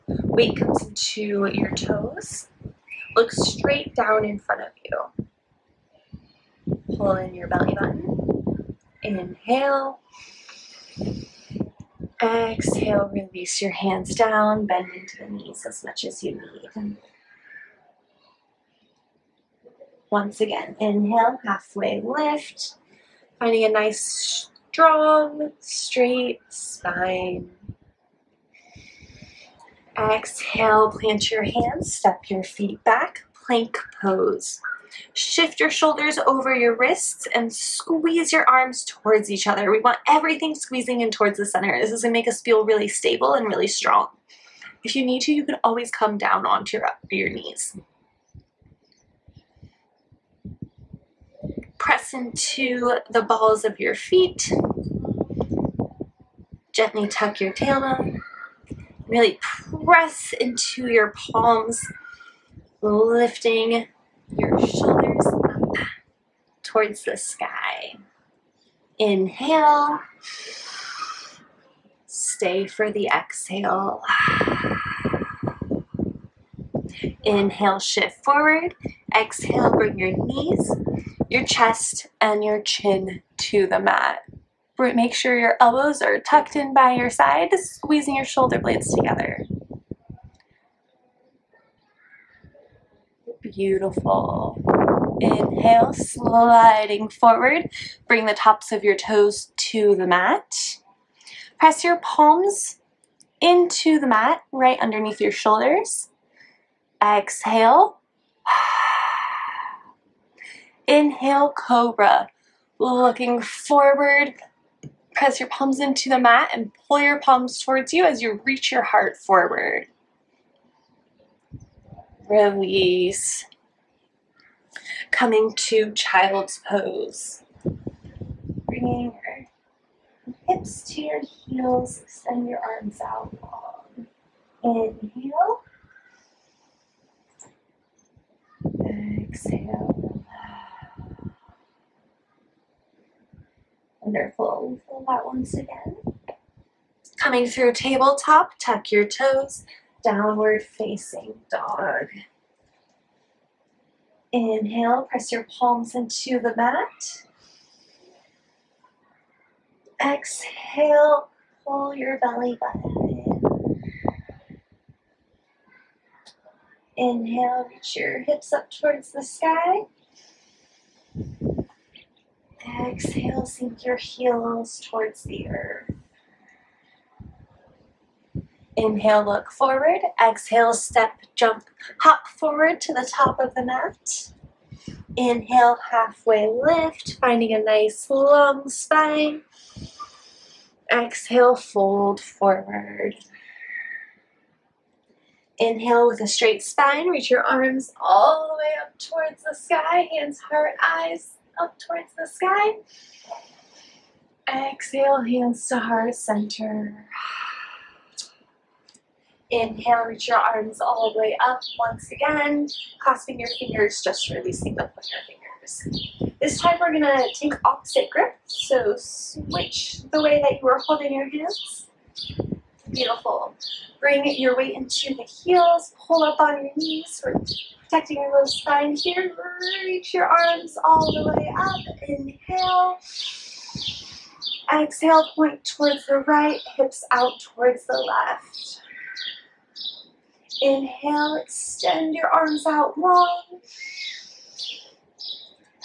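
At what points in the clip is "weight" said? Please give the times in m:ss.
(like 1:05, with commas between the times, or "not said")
0:00, 3:44.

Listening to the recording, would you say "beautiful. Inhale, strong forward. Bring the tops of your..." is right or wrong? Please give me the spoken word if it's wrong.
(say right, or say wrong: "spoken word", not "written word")
wrong: "sliding", not "strong".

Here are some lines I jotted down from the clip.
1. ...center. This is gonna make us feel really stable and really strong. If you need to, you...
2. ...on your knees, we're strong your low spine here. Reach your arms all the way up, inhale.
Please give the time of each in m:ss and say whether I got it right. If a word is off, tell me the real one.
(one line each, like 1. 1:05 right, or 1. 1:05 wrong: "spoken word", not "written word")
1. 0:41 right
2. 3:46 wrong: "protecting", not "strong".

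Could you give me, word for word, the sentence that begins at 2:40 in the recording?
Exhale, pull your belly button in.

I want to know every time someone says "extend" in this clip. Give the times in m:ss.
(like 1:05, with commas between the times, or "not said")
2:12, 4:01.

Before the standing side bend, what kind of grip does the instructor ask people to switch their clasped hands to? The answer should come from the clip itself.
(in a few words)
opposite grip.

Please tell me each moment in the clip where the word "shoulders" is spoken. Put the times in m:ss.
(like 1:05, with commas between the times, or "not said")
0:35, 1:04, 1:28, 1:45.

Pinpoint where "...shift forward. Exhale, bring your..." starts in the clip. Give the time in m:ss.
1:17.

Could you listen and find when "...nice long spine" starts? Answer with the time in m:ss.
3:07.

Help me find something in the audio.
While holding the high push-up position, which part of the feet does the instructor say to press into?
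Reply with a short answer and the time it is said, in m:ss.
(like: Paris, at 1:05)
balls of your feet, at 0:53.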